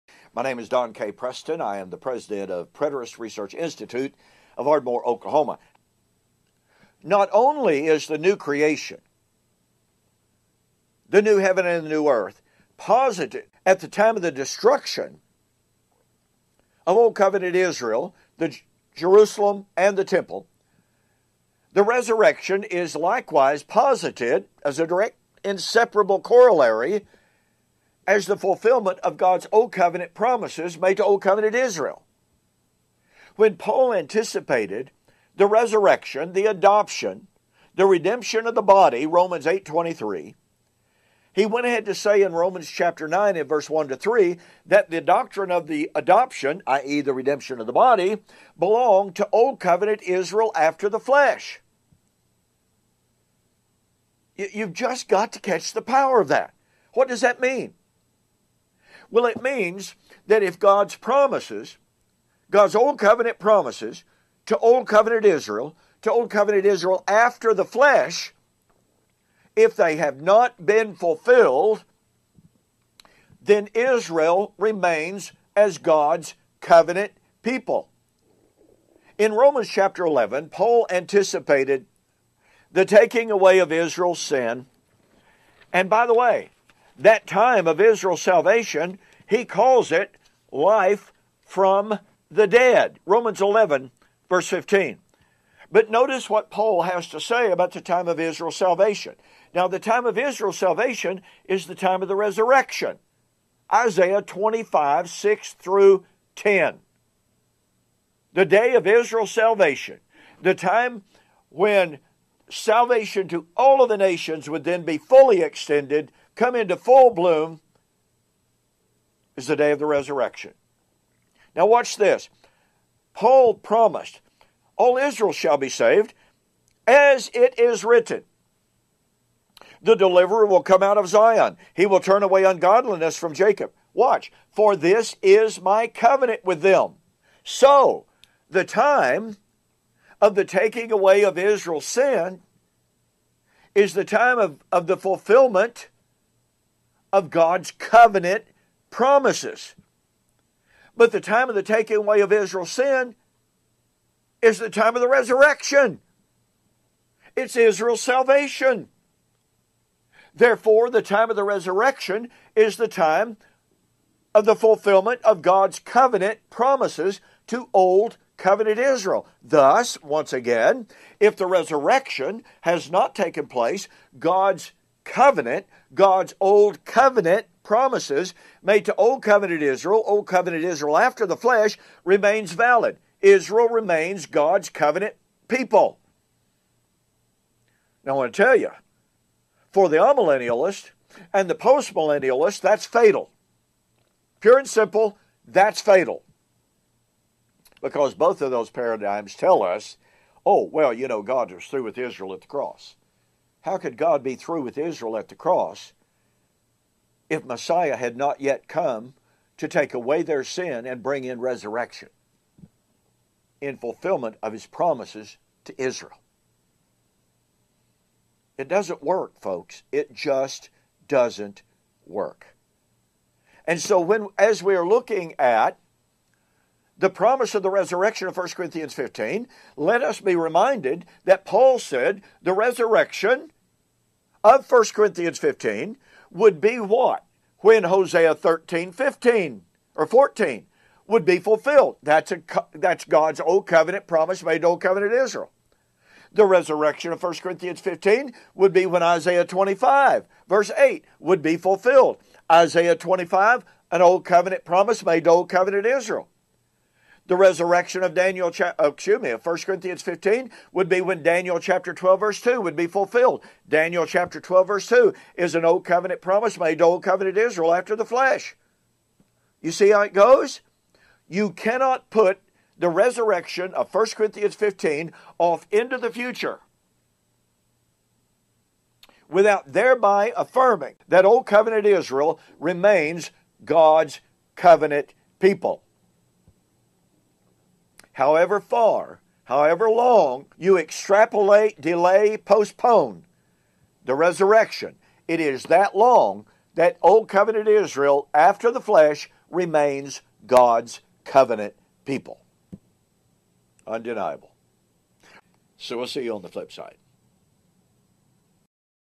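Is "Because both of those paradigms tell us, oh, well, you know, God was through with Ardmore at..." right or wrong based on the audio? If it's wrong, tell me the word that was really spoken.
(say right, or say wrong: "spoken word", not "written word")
wrong: "Israel", not "Ardmore".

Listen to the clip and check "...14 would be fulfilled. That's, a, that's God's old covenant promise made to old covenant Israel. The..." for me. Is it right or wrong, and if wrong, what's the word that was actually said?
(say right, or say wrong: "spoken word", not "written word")
right.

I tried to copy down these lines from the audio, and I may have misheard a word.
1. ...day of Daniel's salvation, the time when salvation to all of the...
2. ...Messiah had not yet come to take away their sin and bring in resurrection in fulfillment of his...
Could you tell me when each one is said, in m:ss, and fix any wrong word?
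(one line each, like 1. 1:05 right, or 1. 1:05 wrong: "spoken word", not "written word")
1. 1:48 wrong: "Israel", not "Daniel"
2. 3:27 right.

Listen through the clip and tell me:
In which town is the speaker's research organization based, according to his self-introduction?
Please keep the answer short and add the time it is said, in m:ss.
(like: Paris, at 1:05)
Ardmore, Oklahoma, at 0:04.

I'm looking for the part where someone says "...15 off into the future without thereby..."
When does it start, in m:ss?
4:34.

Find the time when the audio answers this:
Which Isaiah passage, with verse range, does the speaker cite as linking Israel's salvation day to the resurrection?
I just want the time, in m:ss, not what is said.
1:43.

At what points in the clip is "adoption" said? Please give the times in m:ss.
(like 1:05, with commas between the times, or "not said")
0:36, 0:45.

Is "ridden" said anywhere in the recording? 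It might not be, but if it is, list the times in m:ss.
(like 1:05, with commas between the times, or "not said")
not said.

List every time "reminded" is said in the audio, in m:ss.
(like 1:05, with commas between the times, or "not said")
3:50.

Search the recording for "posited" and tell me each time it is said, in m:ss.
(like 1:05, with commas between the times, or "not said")
0:12, 0:23.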